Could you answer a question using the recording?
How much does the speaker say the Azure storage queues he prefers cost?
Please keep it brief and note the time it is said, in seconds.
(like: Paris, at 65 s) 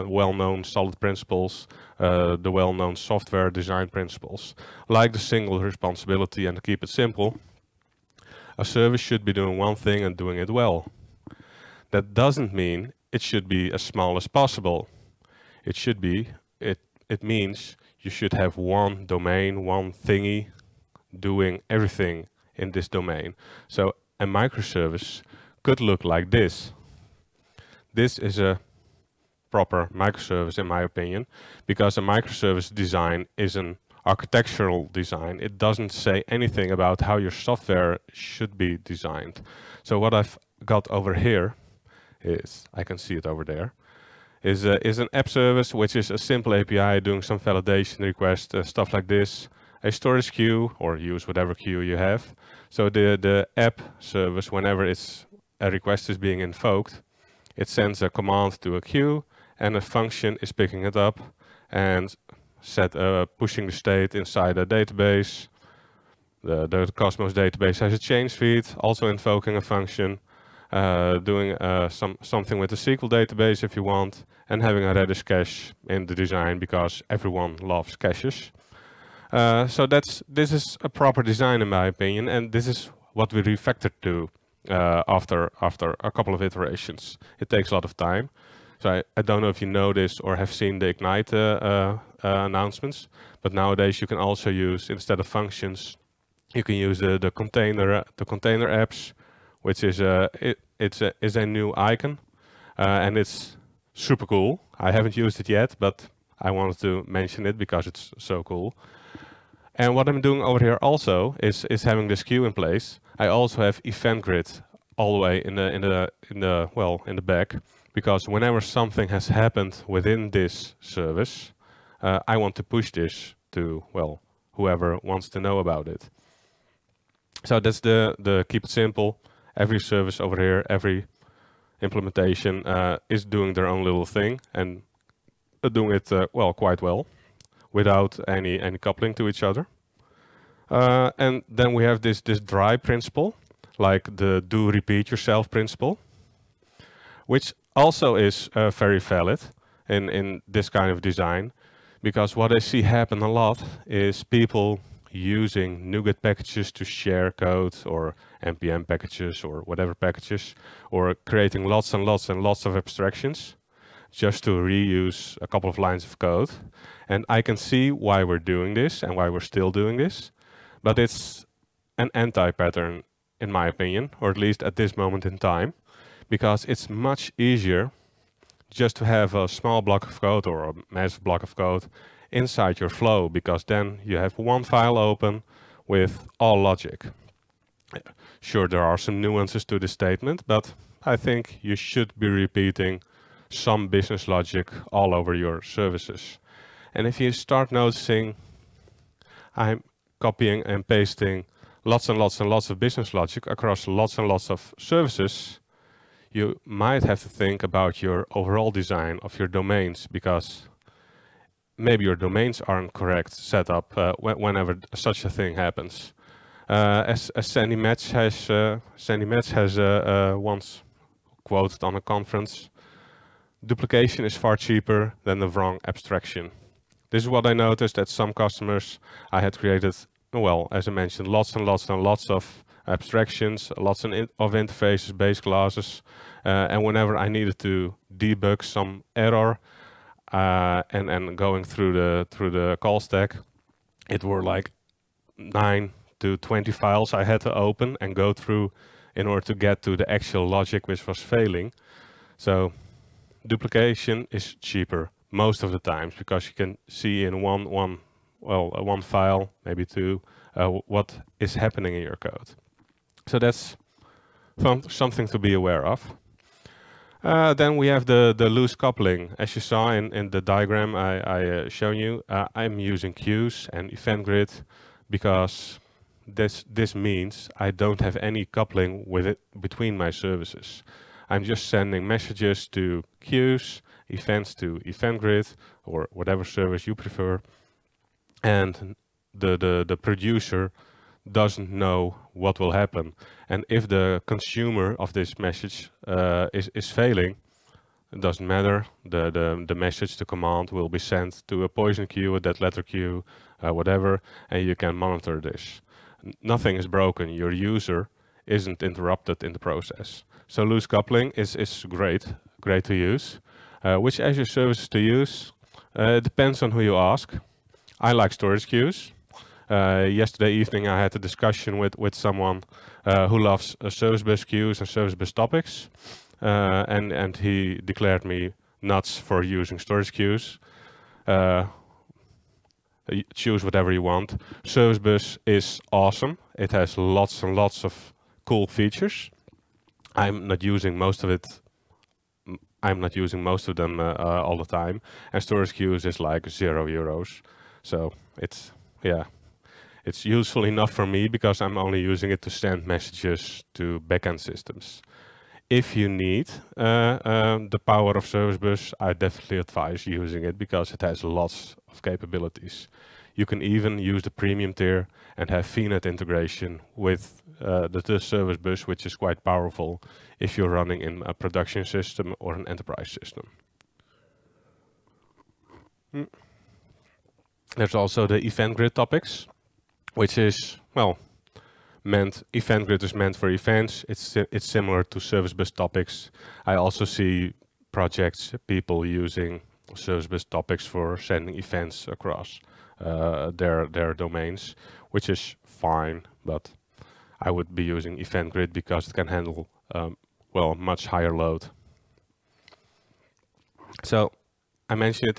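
zero euros, at 346 s.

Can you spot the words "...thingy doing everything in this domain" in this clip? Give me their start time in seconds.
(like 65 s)
20 s.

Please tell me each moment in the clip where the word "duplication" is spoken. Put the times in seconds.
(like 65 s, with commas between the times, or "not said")
223 s, 253 s.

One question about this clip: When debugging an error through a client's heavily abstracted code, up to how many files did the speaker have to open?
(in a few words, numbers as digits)
20.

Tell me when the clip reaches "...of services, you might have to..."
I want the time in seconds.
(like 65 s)
204 s.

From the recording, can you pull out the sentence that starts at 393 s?
Uh, their their domains, which is fine.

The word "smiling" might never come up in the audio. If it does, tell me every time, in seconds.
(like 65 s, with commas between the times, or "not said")
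not said.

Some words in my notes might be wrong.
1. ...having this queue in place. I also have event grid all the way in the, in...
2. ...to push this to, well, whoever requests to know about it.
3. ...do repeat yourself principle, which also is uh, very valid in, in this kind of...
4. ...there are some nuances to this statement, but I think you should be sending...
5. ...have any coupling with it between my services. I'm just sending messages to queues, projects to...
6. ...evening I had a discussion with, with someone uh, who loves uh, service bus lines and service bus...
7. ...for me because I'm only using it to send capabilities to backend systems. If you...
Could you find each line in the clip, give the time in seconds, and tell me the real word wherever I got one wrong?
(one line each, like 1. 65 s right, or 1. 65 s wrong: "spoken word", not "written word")
1. 111 s right
2. 122 s wrong: "wants", not "requests"
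3. 144 s right
4. 188 s wrong: "repeating", not "sending"
5. 278 s wrong: "events", not "projects"
6. 320 s wrong: "queues", not "lines"
7. 350 s wrong: "messages", not "capabilities".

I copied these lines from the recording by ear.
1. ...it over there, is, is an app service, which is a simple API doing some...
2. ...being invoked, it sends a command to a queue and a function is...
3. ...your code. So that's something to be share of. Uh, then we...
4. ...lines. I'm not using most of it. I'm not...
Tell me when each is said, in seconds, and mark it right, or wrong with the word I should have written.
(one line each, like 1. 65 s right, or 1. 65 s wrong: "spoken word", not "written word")
1. 43 s right
2. 56 s right
3. 262 s wrong: "aware", not "share"
4. 338 s wrong: "features", not "lines".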